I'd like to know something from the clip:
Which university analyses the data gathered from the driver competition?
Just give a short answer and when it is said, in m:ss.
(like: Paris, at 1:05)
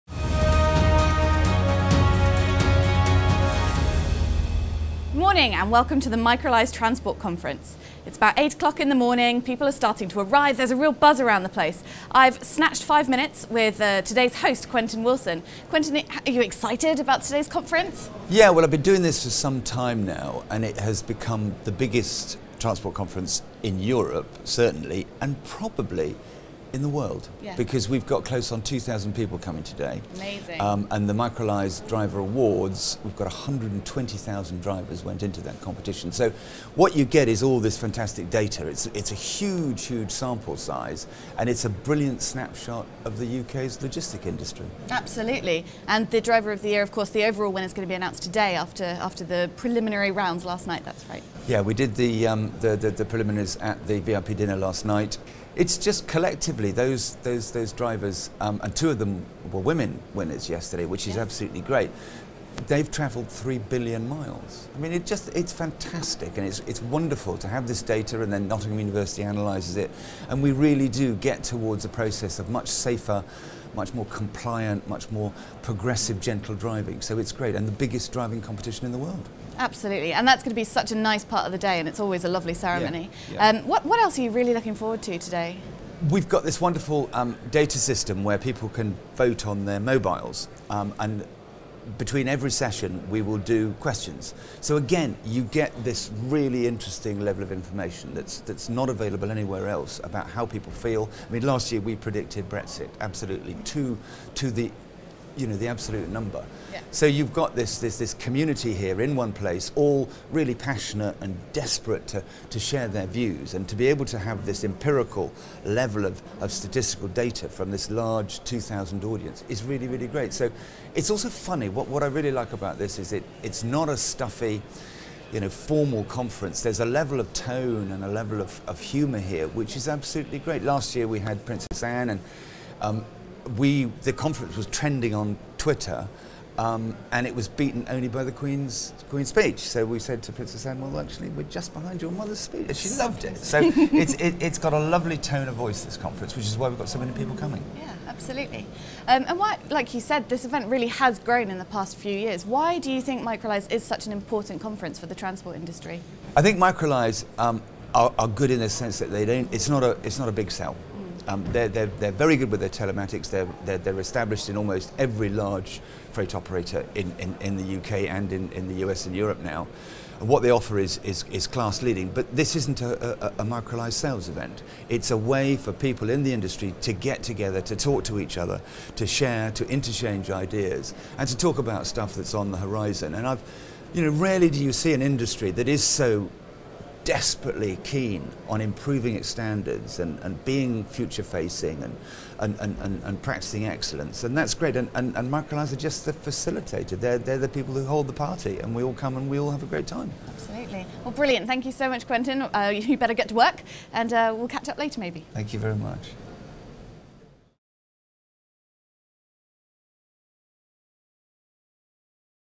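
Nottingham University, at 1:08.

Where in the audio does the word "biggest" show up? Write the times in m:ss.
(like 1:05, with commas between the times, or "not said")
0:21, 1:17.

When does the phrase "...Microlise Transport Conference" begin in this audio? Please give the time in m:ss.
0:06.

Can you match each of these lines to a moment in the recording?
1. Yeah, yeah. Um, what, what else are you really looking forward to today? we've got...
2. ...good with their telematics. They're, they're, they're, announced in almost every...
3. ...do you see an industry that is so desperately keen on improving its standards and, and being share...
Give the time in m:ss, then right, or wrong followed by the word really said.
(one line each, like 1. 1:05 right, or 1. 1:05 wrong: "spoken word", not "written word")
1. 1:23 right
2. 2:42 wrong: "established", not "announced"
3. 3:04 wrong: "future", not "share".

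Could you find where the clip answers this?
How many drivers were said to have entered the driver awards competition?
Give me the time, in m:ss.
0:33.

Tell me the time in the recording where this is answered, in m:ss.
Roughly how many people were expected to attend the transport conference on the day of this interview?
0:28.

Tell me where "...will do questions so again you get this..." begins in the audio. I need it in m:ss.
1:33.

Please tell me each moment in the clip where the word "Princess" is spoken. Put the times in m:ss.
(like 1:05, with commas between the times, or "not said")
2:11, 2:20.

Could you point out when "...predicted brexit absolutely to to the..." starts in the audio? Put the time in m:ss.
1:41.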